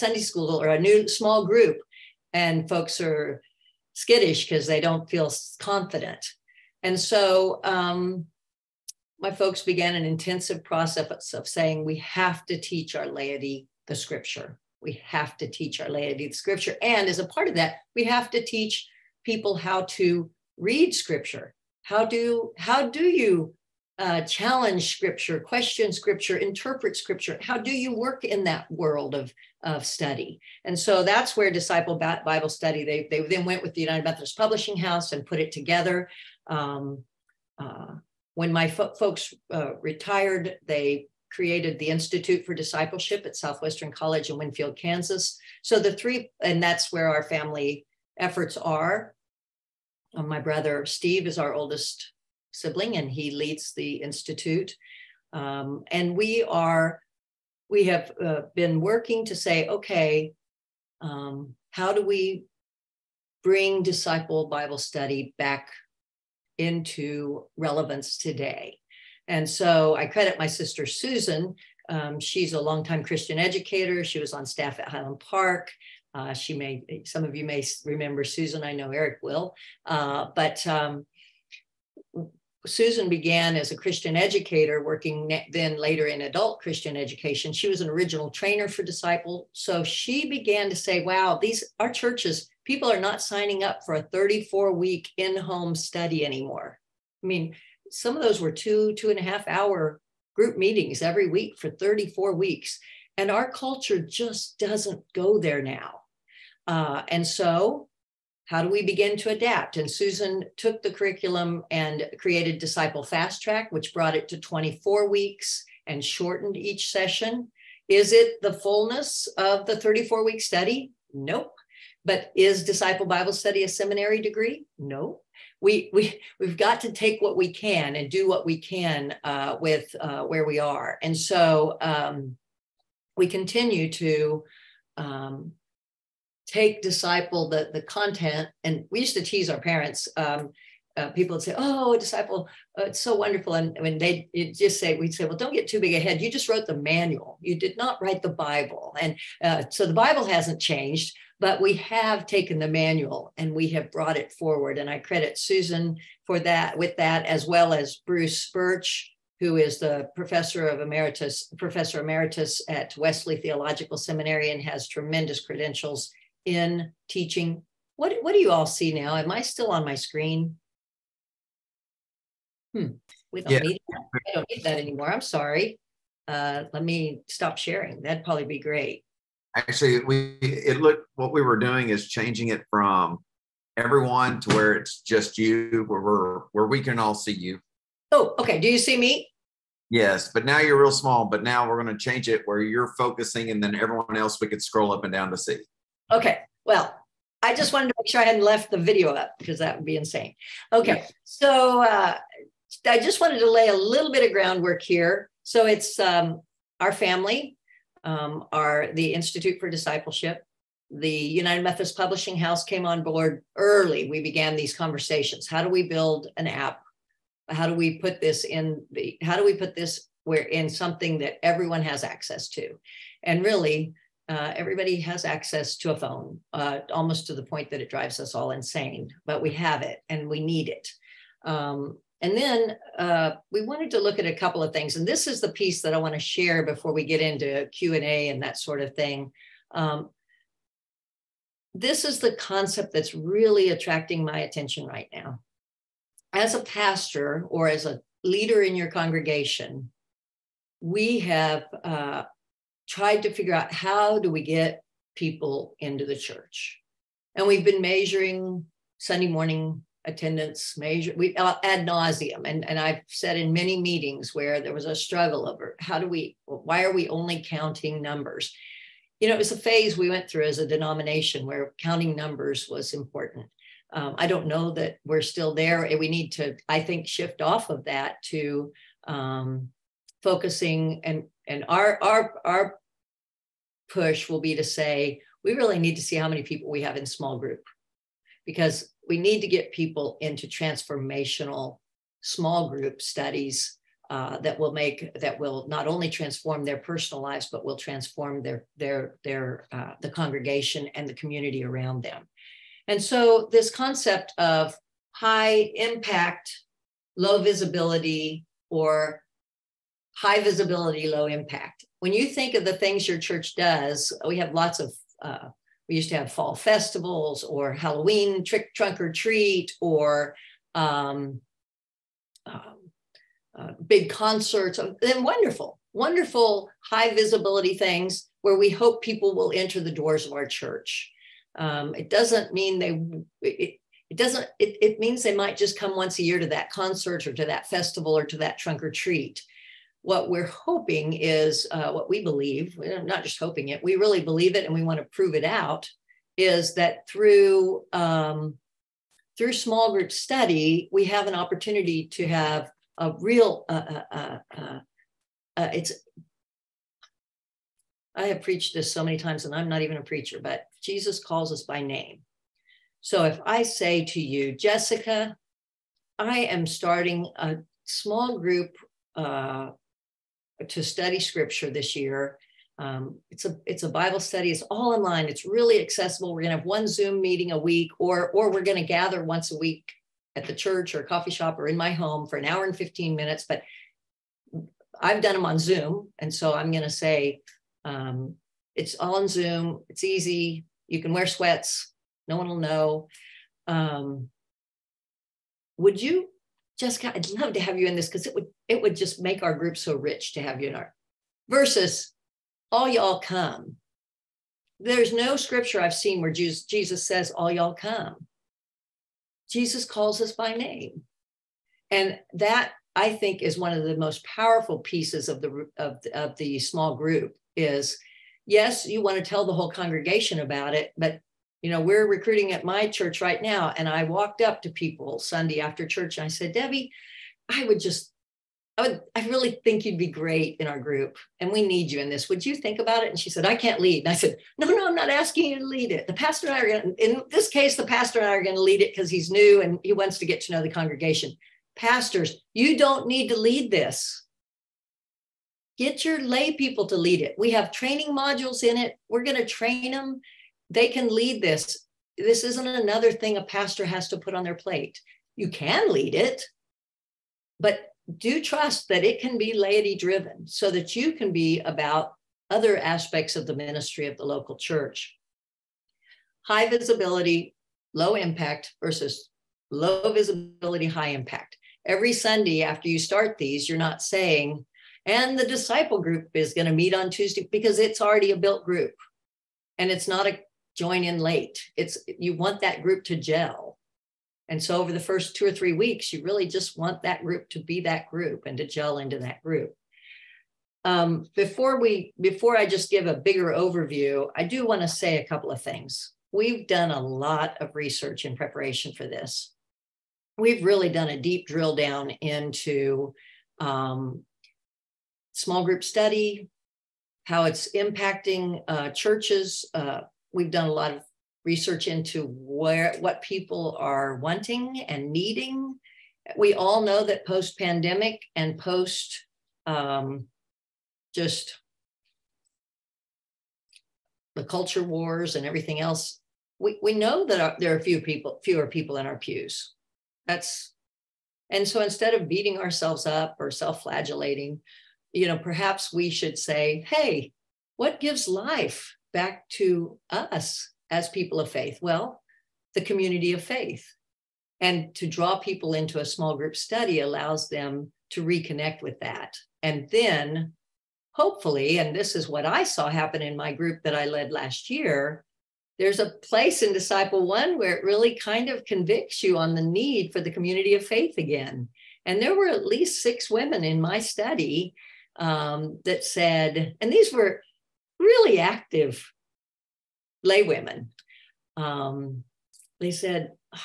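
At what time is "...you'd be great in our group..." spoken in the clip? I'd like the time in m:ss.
7:09.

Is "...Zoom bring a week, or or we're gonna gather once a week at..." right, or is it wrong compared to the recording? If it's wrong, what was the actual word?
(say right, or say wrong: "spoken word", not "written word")
wrong: "meeting", not "bring".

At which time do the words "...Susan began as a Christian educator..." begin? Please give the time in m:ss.
1:22.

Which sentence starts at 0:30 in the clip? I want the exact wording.
And so that's where Disciple Bible Study, they, they then went with the United Methodist Publishing House and put it together.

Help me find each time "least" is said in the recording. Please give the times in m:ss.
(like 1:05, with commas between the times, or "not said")
9:22.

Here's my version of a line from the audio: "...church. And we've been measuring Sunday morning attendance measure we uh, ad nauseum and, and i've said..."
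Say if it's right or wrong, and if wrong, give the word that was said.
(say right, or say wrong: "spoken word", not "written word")
right.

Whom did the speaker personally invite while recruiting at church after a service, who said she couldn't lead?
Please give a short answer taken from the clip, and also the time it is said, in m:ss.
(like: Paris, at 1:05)
Debbie, at 7:06.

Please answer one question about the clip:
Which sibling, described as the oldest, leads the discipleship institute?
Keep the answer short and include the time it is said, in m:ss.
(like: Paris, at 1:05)
Steve, at 0:50.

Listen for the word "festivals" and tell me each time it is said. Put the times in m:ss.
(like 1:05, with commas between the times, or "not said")
5:16, 5:37.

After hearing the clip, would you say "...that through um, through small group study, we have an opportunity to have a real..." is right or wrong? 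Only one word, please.
right.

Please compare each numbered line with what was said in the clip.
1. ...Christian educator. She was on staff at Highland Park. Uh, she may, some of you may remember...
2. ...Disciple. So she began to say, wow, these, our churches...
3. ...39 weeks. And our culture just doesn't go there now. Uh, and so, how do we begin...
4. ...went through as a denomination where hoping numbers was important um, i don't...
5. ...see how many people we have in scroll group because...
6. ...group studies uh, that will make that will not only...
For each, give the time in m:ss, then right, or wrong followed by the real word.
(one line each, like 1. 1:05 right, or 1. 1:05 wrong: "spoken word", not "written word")
1. 1:13 right
2. 1:28 right
3. 1:41 wrong: "34", not "39"
4. 4:30 wrong: "counting", not "hoping"
5. 4:46 wrong: "small", not "scroll"
6. 4:52 right.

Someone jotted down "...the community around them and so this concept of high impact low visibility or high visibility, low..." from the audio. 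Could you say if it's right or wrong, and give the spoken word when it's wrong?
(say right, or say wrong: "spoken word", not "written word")
right.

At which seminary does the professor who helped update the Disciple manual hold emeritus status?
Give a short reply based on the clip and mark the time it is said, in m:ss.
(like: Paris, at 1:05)
Wesley Theological Seminary, at 2:42.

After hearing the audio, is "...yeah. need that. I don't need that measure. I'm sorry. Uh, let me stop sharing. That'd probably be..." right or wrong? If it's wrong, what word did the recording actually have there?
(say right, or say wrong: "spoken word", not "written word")
wrong: "anymore", not "measure".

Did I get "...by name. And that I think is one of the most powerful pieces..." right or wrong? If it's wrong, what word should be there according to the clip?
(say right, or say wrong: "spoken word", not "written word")
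right.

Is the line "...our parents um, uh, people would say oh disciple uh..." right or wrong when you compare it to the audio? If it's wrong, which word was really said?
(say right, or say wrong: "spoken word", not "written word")
right.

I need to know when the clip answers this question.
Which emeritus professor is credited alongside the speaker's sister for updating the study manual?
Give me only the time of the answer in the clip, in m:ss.
2:38.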